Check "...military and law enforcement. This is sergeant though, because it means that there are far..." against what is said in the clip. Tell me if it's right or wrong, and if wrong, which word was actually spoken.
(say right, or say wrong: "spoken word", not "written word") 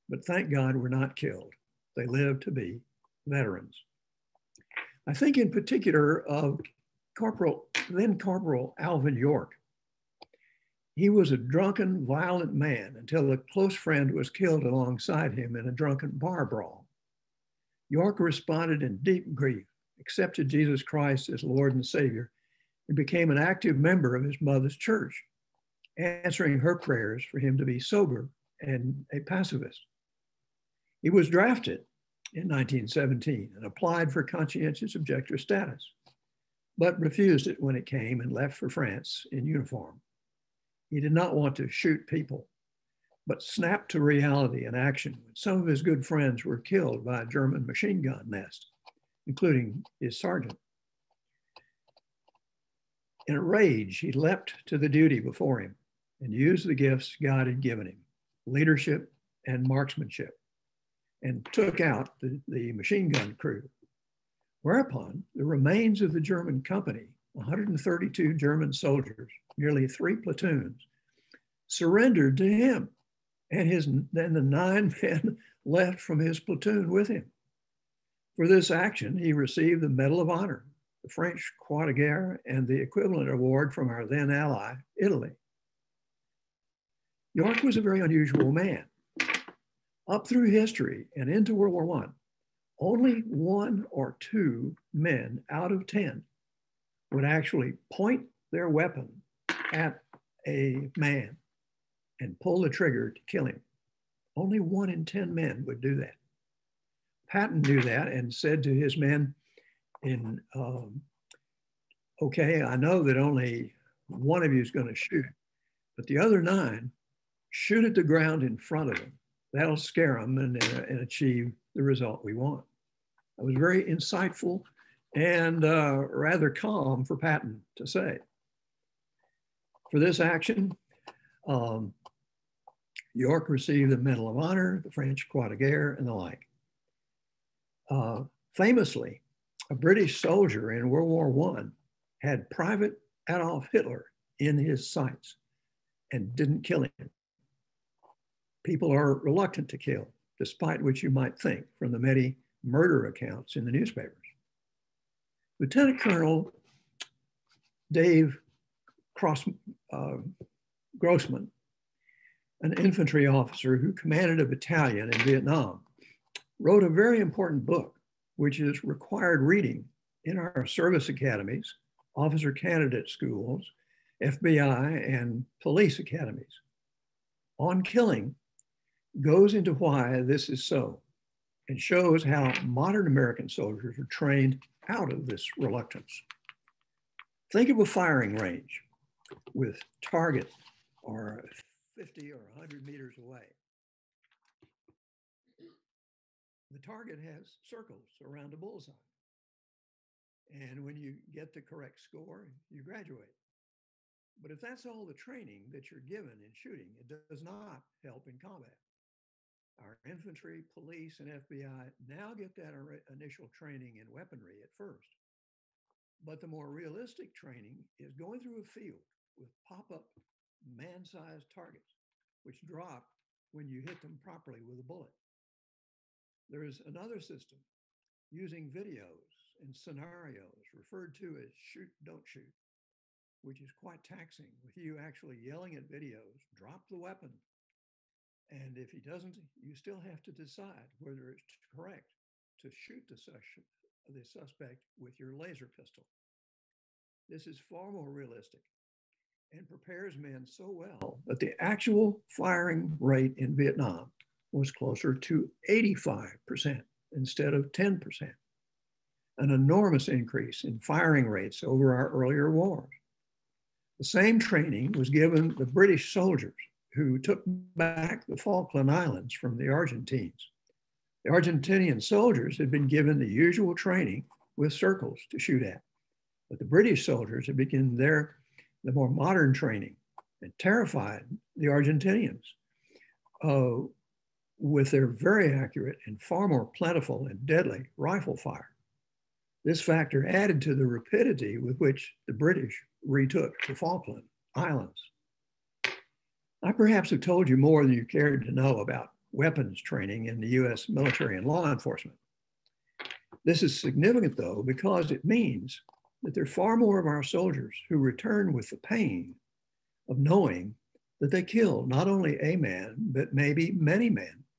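wrong: "significant", not "sergeant".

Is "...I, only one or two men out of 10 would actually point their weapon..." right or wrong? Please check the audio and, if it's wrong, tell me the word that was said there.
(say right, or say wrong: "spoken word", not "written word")
right.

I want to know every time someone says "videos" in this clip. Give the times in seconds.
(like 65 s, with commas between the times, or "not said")
228 s, 235 s.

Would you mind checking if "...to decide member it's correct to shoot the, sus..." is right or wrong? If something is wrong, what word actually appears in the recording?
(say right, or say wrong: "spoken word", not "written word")
wrong: "whether", not "member".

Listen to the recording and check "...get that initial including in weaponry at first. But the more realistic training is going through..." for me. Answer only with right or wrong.
wrong.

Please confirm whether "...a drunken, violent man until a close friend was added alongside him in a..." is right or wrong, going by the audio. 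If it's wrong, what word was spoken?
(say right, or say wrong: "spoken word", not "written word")
wrong: "killed", not "added".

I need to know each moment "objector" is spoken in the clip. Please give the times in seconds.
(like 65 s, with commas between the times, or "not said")
34 s.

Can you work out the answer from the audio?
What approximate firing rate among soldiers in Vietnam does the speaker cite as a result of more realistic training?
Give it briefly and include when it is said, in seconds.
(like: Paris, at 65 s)
85%, at 255 s.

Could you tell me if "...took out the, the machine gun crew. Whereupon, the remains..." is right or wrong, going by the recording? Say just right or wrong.
right.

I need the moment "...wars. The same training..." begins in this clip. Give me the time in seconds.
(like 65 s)
262 s.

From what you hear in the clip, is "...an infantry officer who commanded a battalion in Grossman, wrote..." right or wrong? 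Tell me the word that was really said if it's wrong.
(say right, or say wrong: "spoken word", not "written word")
wrong: "Vietnam", not "Grossman".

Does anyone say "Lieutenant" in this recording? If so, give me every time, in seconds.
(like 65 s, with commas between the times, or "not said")
155 s.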